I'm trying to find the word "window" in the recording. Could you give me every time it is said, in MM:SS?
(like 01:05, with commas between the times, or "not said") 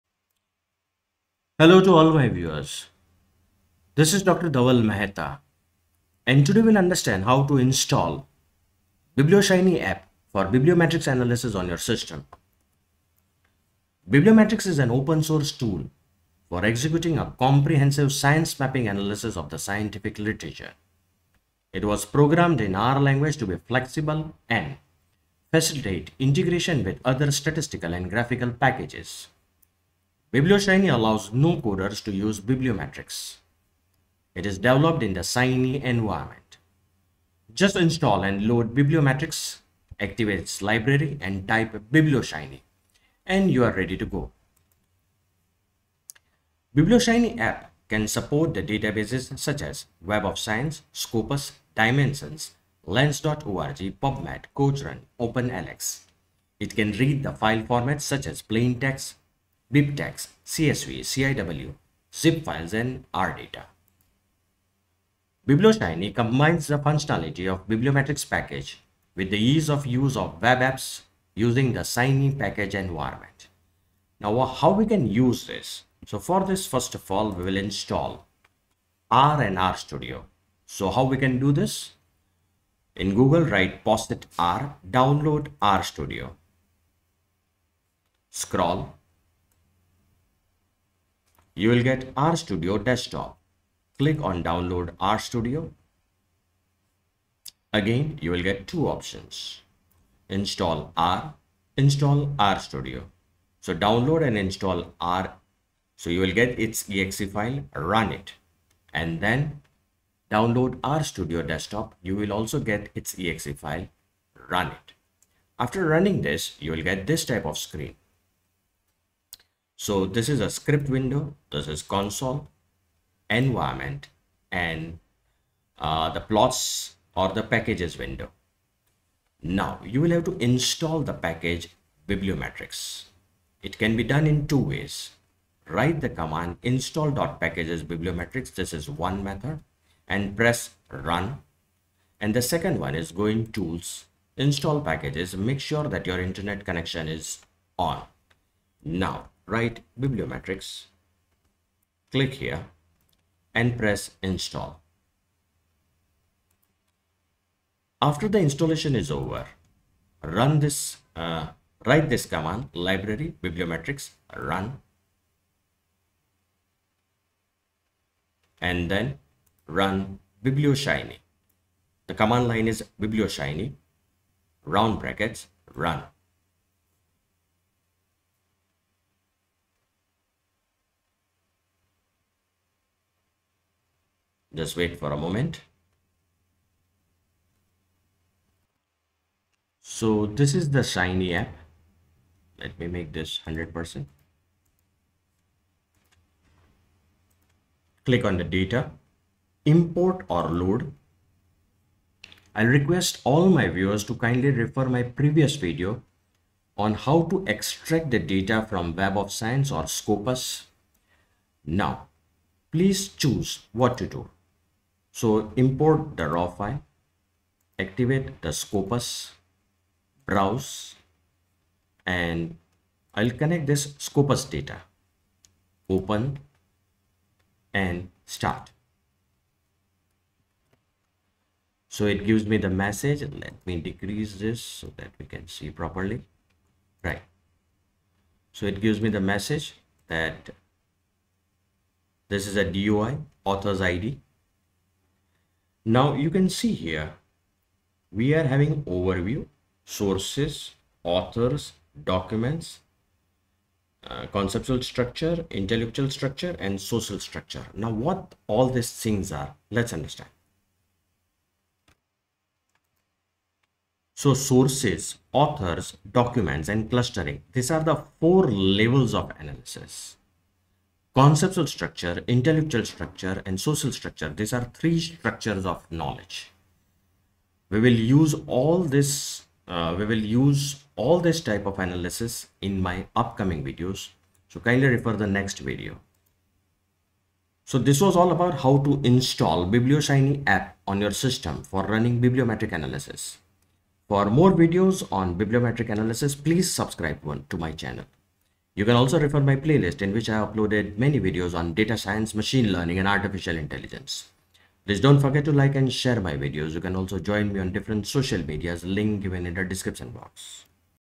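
02:00, 02:08.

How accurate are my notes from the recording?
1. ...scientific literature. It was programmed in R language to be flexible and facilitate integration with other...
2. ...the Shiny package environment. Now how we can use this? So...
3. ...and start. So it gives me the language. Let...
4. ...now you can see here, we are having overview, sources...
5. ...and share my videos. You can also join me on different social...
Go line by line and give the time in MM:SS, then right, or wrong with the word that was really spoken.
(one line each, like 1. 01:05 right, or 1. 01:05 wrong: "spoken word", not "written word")
1. 00:19 right
2. 01:11 right
3. 03:47 wrong: "message", not "language"
4. 04:05 right
5. 05:05 right.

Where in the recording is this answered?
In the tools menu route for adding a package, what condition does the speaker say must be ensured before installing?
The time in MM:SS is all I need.
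02:26.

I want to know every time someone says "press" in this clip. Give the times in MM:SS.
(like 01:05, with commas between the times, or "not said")
02:20, 02:33.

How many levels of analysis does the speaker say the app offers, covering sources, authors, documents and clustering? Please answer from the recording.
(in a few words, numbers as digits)
4.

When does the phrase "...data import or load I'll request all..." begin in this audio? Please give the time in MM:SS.
03:18.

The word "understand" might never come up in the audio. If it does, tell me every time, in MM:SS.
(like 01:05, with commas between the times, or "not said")
00:06, 04:19.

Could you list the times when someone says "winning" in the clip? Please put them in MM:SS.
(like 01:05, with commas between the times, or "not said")
not said.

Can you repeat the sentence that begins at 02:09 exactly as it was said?
Now you will have to install the package bibliometrix.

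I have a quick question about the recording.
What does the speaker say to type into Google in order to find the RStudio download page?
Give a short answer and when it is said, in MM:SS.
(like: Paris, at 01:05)
POSIT R, at 01:23.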